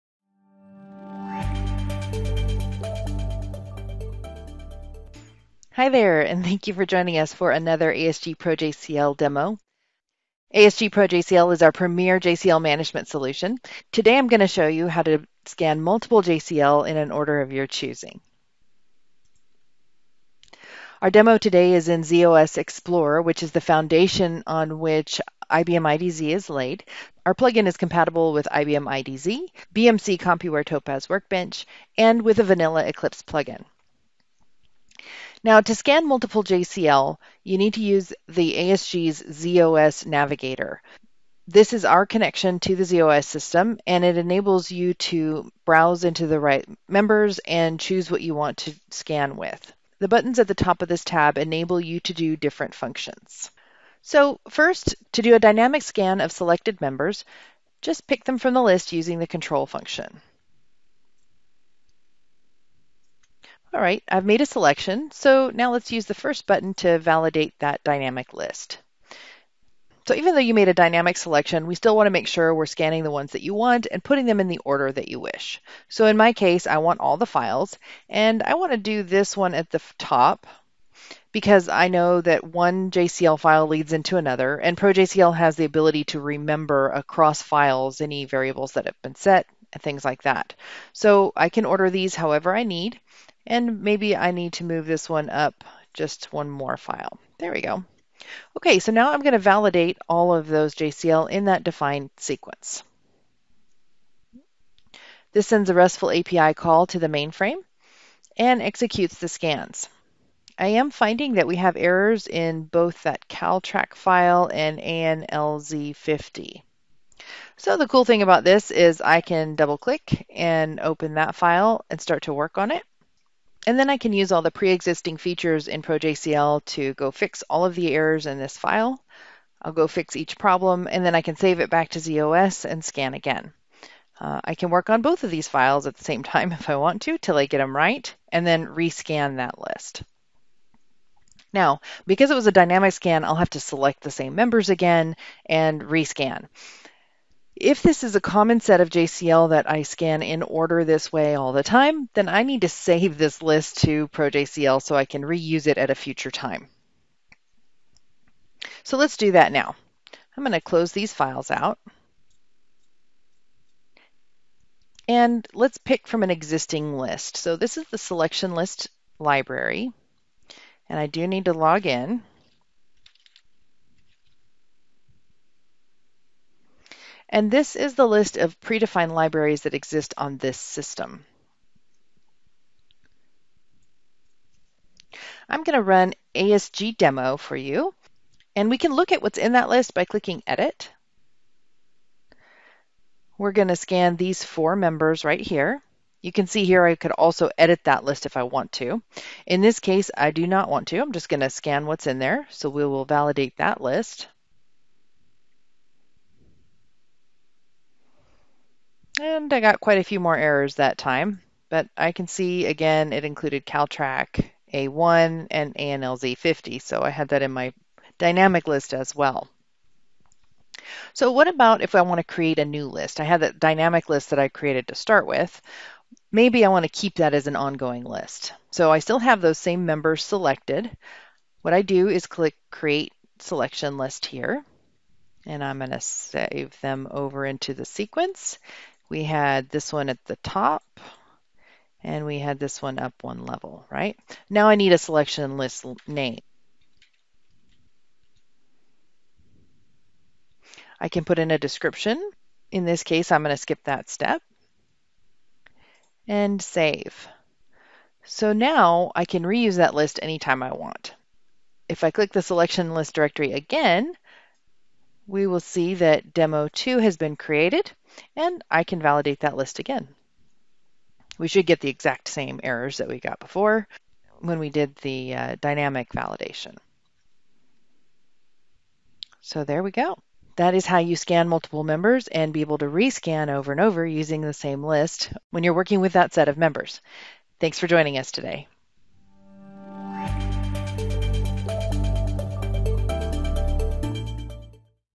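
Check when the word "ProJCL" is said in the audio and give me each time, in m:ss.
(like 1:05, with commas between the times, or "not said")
1:24, 2:05, 2:34.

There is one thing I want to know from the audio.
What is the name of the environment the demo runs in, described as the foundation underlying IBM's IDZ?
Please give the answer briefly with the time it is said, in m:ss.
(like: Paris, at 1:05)
ZOS Explorer, at 0:22.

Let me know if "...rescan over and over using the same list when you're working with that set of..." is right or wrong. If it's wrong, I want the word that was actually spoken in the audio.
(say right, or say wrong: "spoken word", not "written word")
right.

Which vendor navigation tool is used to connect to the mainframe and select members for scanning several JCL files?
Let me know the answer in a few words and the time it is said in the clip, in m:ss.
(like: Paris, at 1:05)
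ASG's ZOS Navigator, at 0:38.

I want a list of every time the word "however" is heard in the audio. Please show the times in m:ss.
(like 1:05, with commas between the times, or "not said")
1:32.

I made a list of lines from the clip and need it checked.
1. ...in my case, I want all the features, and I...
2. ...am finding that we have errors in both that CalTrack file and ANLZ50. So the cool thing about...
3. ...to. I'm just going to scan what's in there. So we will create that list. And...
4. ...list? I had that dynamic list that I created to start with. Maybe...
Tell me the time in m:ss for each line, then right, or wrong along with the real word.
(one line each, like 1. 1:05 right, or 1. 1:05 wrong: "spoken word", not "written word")
1. 1:16 wrong: "files", not "features"
2. 1:50 right
3. 3:20 wrong: "validate", not "create"
4. 3:42 right.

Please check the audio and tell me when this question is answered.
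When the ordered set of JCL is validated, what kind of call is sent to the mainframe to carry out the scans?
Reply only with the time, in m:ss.
1:45.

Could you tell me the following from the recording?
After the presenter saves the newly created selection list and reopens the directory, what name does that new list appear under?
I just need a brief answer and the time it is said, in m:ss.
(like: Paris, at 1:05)
demo 2, at 4:26.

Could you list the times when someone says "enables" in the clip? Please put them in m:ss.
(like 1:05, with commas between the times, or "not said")
0:44, 0:51.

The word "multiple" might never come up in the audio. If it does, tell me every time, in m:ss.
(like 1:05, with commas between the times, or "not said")
0:15, 0:36, 4:41.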